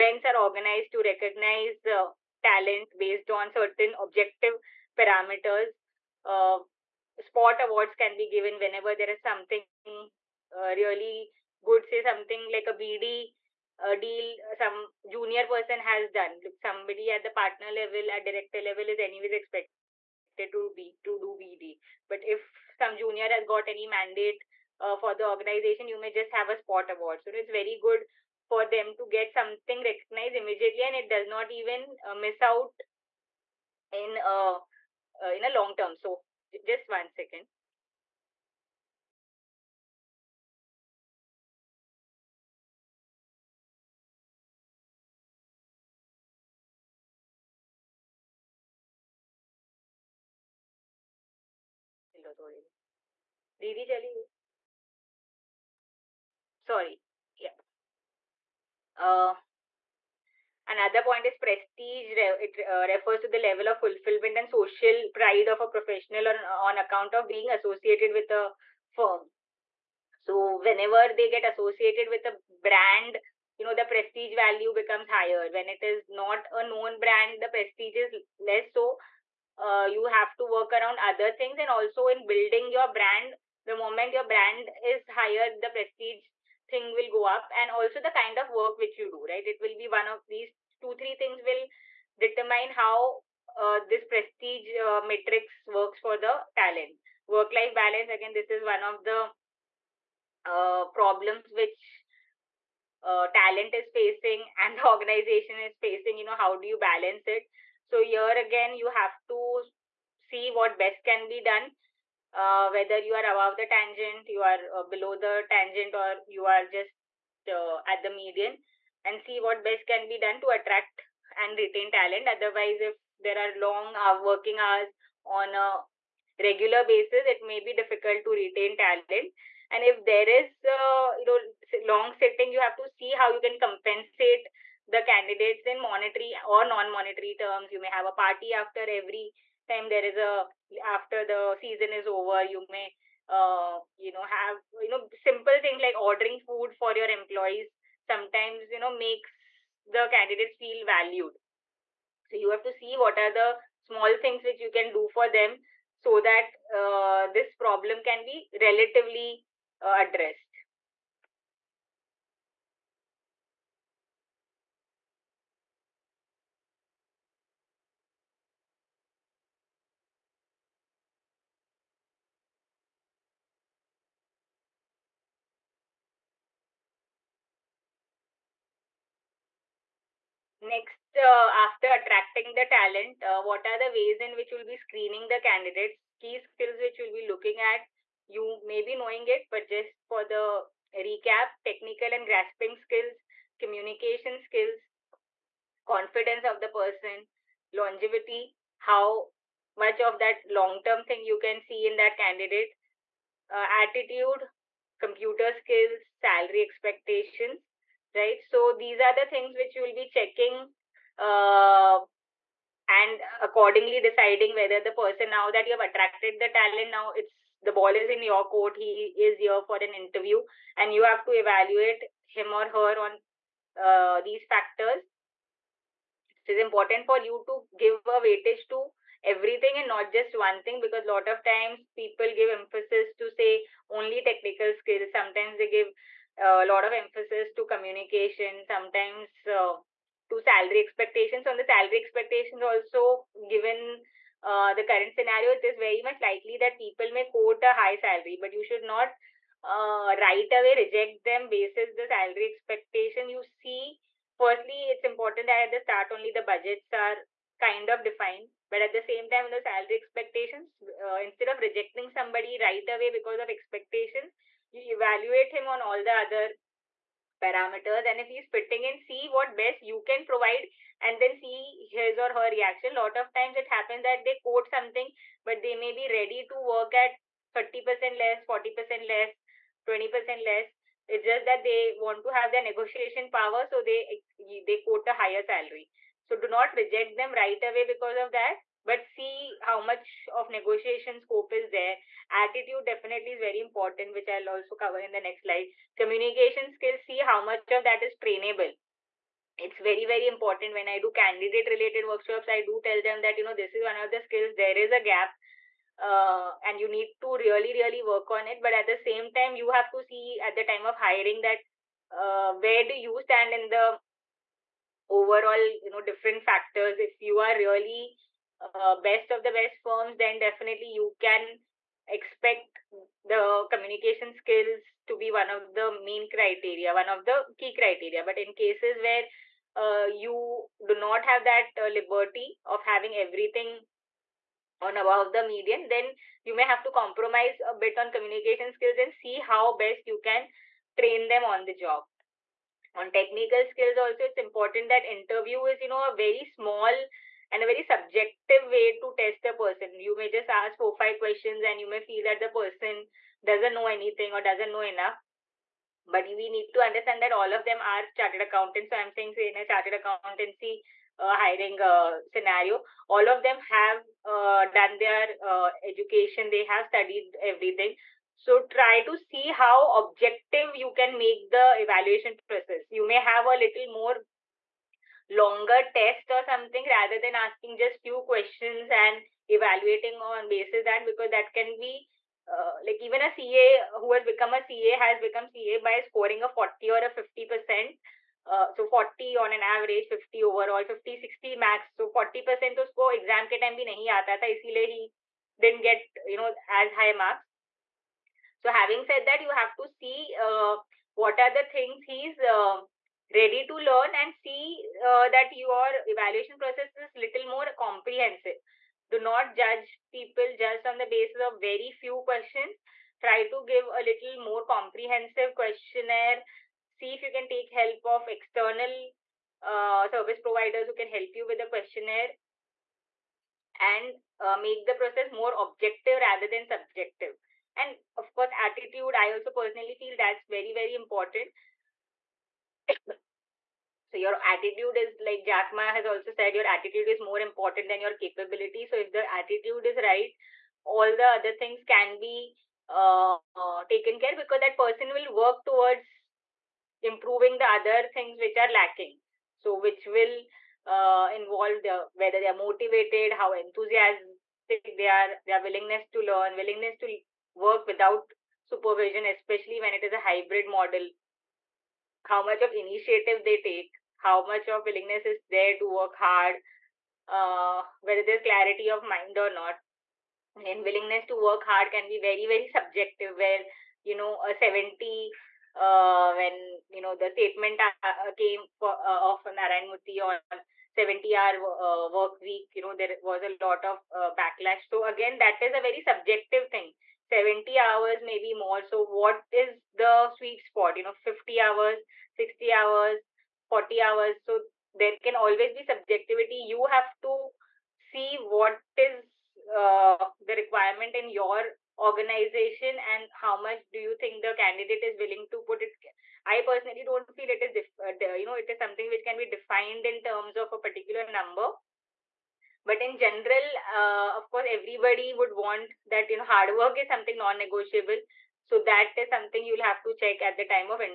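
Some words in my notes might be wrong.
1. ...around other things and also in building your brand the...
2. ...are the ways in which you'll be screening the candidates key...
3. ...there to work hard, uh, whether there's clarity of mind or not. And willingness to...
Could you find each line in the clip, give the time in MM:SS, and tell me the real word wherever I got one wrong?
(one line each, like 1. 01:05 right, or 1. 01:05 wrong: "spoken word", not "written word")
1. 01:20 right
2. 03:03 right
3. 07:45 right.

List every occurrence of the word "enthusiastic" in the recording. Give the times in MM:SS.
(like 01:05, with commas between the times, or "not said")
07:33.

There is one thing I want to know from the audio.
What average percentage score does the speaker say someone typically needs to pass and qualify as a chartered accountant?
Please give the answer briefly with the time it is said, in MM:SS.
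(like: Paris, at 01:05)
40%, at 06:28.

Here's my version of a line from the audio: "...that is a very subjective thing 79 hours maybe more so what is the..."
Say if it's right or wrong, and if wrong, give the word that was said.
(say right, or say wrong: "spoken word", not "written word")
wrong: "70", not "79".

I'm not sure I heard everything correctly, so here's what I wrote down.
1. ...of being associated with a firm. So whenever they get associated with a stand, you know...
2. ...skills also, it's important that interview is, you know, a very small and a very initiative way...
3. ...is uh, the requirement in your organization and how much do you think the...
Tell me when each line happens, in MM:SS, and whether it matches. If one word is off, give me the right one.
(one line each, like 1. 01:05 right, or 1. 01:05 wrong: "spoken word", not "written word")
1. 01:07 wrong: "brand", not "stand"
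2. 05:43 wrong: "subjective", not "initiative"
3. 08:18 right.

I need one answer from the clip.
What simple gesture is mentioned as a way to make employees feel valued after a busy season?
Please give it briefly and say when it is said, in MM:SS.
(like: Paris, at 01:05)
Ordering food, at 02:25.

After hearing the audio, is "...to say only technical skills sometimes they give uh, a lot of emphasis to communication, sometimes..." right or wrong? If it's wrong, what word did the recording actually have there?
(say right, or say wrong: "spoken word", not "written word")
right.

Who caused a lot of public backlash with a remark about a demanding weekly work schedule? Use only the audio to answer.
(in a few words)
Narayan Murthy.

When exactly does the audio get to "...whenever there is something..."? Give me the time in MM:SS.
00:08.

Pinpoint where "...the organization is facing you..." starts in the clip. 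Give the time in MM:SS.
01:44.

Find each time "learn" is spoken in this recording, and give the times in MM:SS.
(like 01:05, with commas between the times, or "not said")
06:43, 07:36.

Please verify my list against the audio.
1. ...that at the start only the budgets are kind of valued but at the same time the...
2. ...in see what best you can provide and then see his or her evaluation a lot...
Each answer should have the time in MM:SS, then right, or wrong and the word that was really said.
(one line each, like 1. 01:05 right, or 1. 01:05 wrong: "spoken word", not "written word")
1. 04:15 wrong: "defined", not "valued"
2. 04:28 wrong: "reaction", not "evaluation".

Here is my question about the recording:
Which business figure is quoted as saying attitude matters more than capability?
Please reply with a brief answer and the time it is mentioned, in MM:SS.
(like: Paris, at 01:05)
Jack Ma, at 07:15.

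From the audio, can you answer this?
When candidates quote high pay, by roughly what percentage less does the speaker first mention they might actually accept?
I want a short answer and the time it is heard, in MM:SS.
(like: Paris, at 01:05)
30%, at 04:37.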